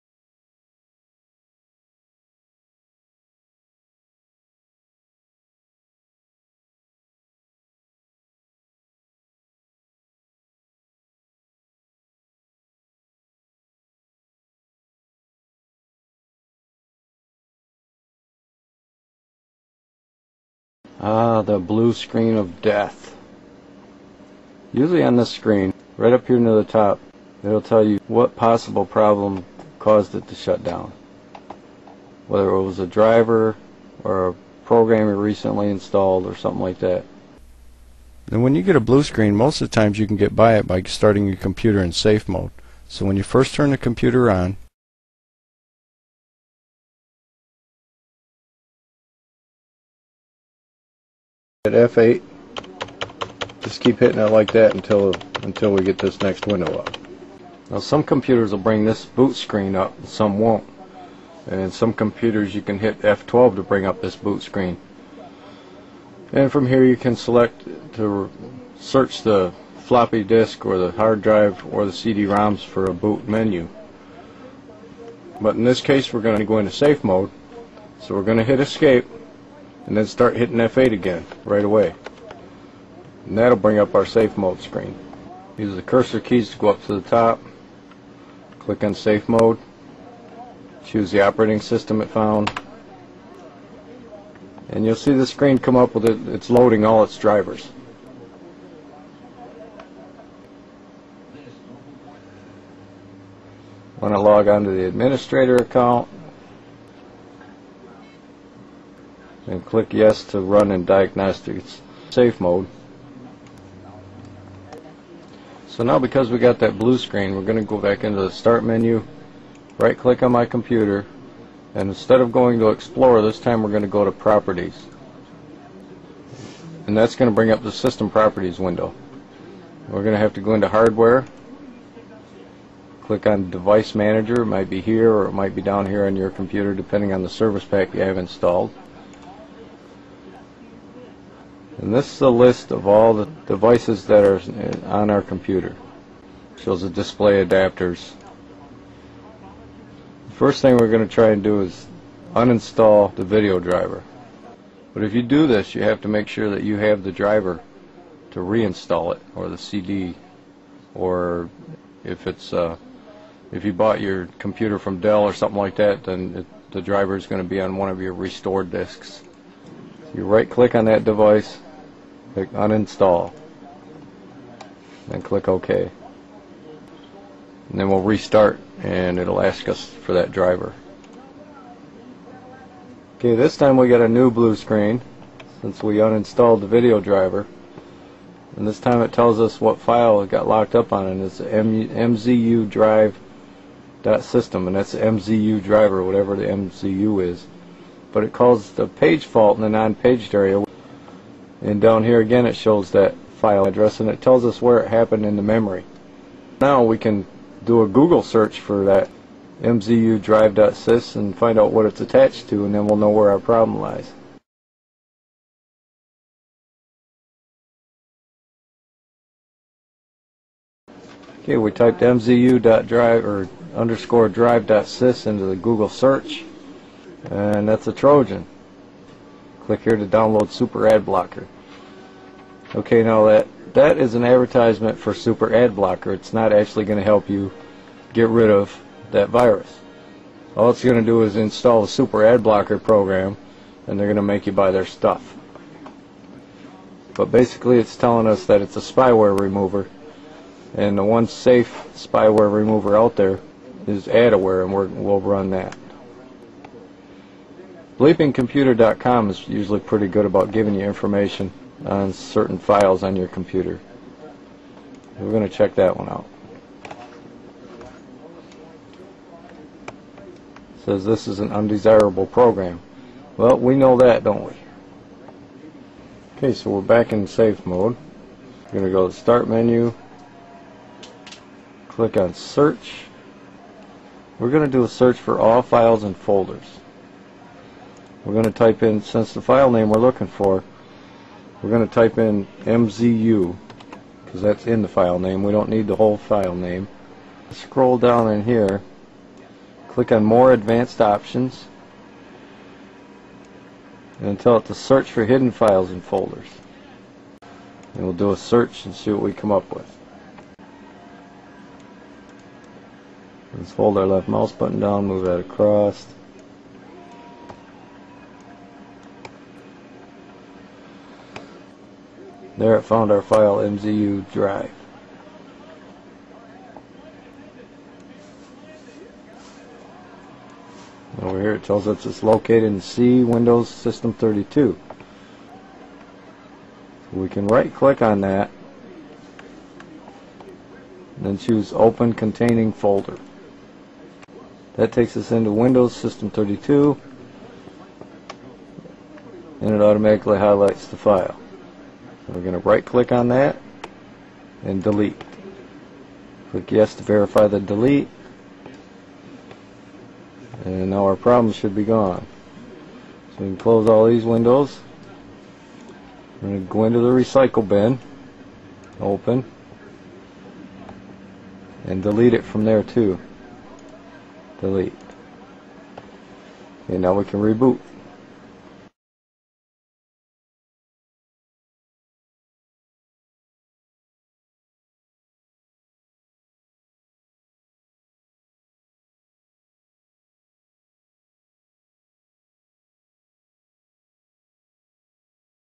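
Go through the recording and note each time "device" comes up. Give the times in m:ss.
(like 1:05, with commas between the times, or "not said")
2:13, 2:23, 2:51.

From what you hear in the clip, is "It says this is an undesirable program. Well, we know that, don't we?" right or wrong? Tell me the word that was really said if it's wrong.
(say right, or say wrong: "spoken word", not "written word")
right.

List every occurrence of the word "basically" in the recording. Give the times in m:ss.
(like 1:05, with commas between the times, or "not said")
4:07.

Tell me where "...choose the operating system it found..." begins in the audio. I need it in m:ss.
1:30.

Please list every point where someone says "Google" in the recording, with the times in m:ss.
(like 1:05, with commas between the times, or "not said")
3:27, 3:45.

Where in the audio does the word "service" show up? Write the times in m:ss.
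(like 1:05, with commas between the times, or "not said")
2:17.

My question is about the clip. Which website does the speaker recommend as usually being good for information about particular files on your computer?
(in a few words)
BleepingComputer.com.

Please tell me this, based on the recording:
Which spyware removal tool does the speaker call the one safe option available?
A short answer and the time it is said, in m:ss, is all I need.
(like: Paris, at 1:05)
AdAware, at 4:14.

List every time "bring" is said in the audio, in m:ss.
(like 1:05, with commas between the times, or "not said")
0:58, 1:03, 1:23, 2:07.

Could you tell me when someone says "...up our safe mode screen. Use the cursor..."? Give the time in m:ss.
1:23.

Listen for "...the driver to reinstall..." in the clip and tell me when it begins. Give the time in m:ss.
2:37.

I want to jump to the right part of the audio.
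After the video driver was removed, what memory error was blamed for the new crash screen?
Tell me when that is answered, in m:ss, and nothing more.
3:18.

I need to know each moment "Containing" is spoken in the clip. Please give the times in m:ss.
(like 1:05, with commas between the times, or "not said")
5:42.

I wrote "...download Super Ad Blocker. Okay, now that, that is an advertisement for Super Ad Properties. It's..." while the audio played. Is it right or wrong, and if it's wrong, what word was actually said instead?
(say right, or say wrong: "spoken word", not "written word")
wrong: "Blocker", not "Properties".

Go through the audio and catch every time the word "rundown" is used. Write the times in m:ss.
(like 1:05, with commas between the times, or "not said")
not said.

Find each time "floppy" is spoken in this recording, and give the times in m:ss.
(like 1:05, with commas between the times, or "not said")
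1:09.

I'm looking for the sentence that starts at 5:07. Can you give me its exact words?
And we'll do a search and see what we come up with.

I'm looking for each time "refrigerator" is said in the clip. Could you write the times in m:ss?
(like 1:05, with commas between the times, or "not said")
not said.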